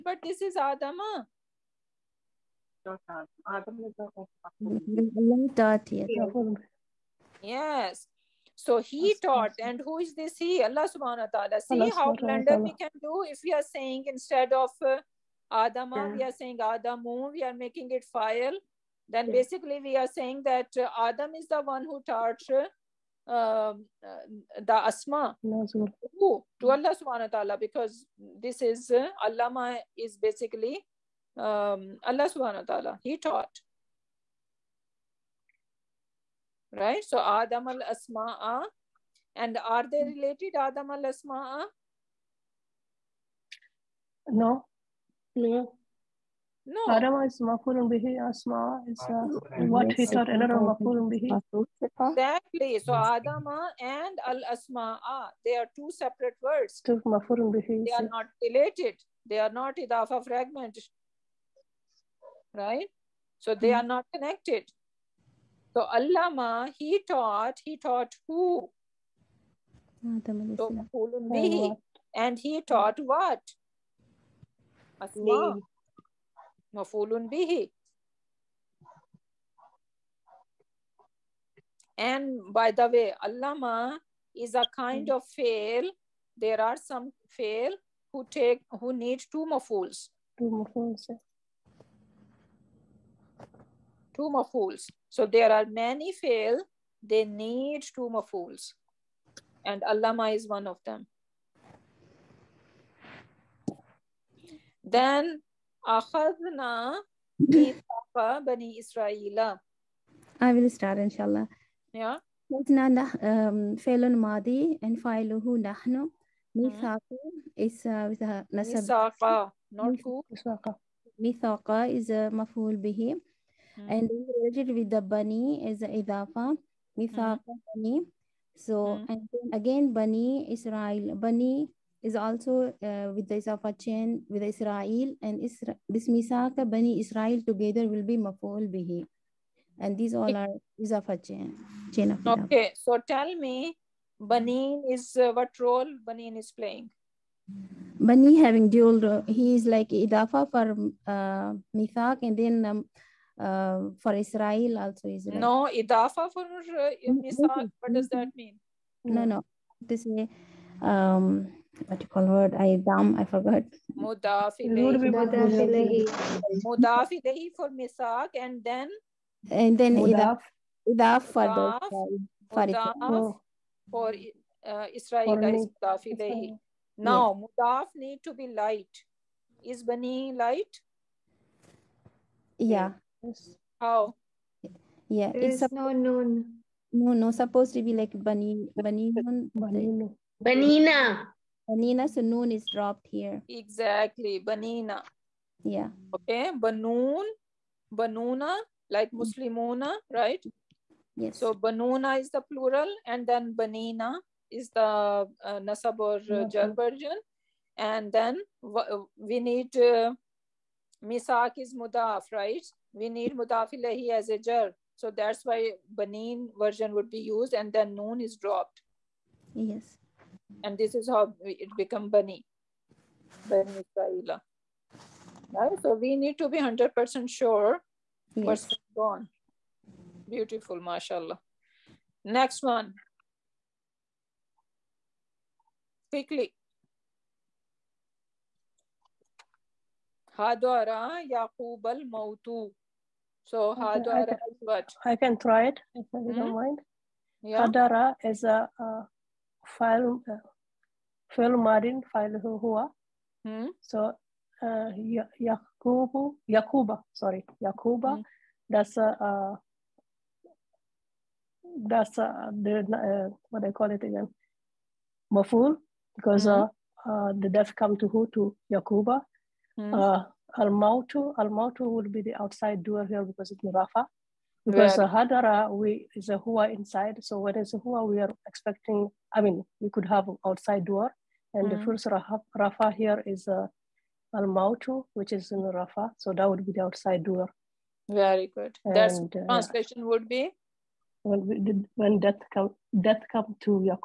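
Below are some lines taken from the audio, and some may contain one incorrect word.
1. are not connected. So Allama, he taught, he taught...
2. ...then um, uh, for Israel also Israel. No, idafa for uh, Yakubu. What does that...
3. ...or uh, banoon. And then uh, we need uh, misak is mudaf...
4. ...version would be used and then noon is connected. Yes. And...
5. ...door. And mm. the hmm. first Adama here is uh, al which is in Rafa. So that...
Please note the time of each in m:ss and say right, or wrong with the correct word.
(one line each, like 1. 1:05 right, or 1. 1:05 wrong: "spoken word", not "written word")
1. 1:03 right
2. 2:32 wrong: "Misak", not "Yakubu"
3. 3:25 wrong: "version", not "banoon"
4. 3:36 wrong: "dropped", not "connected"
5. 4:40 wrong: "Rafa", not "Adama".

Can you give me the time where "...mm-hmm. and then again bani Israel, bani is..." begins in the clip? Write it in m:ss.
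2:08.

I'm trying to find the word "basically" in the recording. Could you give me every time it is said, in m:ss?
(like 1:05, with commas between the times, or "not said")
0:19, 0:30.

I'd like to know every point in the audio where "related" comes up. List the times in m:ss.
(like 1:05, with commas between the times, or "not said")
0:40, 0:58, 2:04.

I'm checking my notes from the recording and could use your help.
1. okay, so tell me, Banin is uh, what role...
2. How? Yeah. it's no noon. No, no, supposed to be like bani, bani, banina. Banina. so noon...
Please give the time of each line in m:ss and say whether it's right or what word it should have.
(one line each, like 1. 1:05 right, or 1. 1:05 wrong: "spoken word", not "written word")
1. 2:22 right
2. 3:03 right.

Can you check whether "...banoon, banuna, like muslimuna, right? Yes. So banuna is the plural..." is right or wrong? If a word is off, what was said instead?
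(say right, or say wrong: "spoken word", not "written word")
right.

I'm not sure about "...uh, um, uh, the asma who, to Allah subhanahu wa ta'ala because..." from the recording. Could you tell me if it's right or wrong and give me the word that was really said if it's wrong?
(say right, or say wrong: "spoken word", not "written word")
right.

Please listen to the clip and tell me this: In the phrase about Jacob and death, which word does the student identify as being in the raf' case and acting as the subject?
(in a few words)
Al-Mautu.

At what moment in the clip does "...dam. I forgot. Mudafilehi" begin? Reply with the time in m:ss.
2:42.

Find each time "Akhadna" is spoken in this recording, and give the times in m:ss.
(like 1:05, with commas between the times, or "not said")
1:45.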